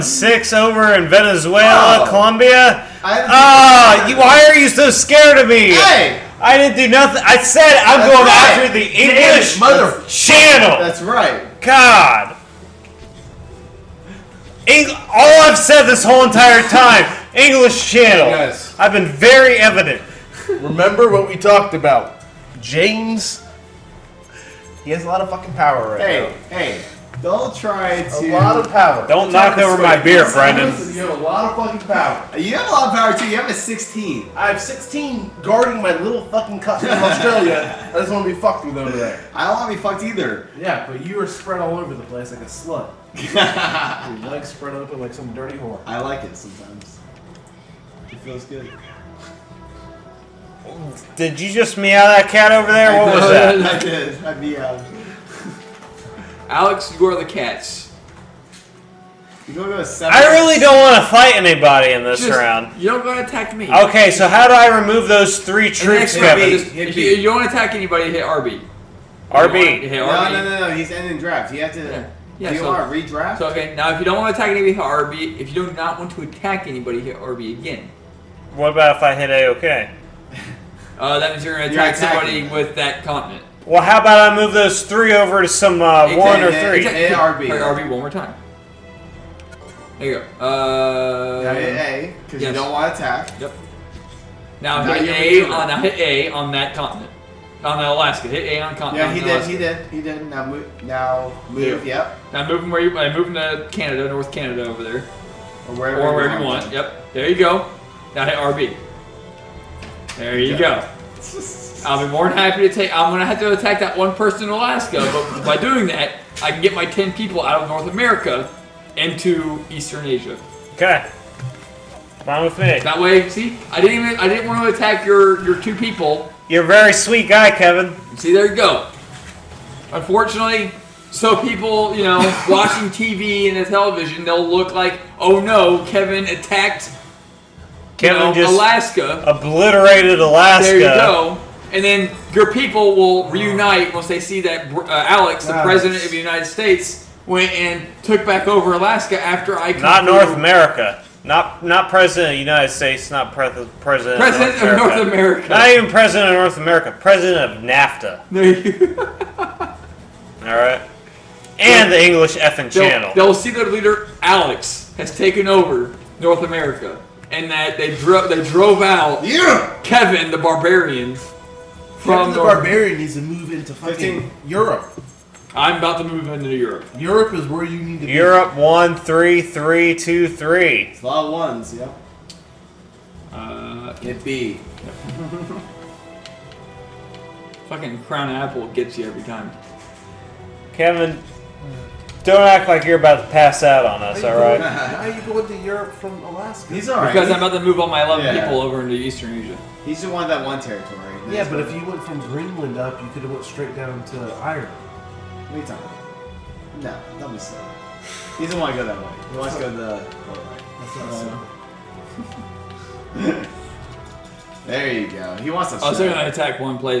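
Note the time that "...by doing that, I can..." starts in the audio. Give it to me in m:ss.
1:55.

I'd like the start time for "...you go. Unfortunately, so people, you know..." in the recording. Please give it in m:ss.
2:08.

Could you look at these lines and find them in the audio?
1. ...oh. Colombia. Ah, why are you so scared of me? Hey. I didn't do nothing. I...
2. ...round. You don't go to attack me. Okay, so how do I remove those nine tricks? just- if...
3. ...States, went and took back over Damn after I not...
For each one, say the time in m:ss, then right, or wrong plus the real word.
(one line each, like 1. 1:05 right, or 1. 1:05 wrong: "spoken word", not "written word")
1. 0:02 right
2. 1:02 wrong: "three", not "nine"
3. 2:26 wrong: "Alaska", not "Damn".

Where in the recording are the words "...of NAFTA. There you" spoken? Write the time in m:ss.
2:37.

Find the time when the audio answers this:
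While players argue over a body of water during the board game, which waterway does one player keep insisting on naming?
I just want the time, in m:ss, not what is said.
0:17.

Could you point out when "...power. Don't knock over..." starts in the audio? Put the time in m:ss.
0:28.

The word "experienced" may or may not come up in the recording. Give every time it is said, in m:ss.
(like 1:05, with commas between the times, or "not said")
not said.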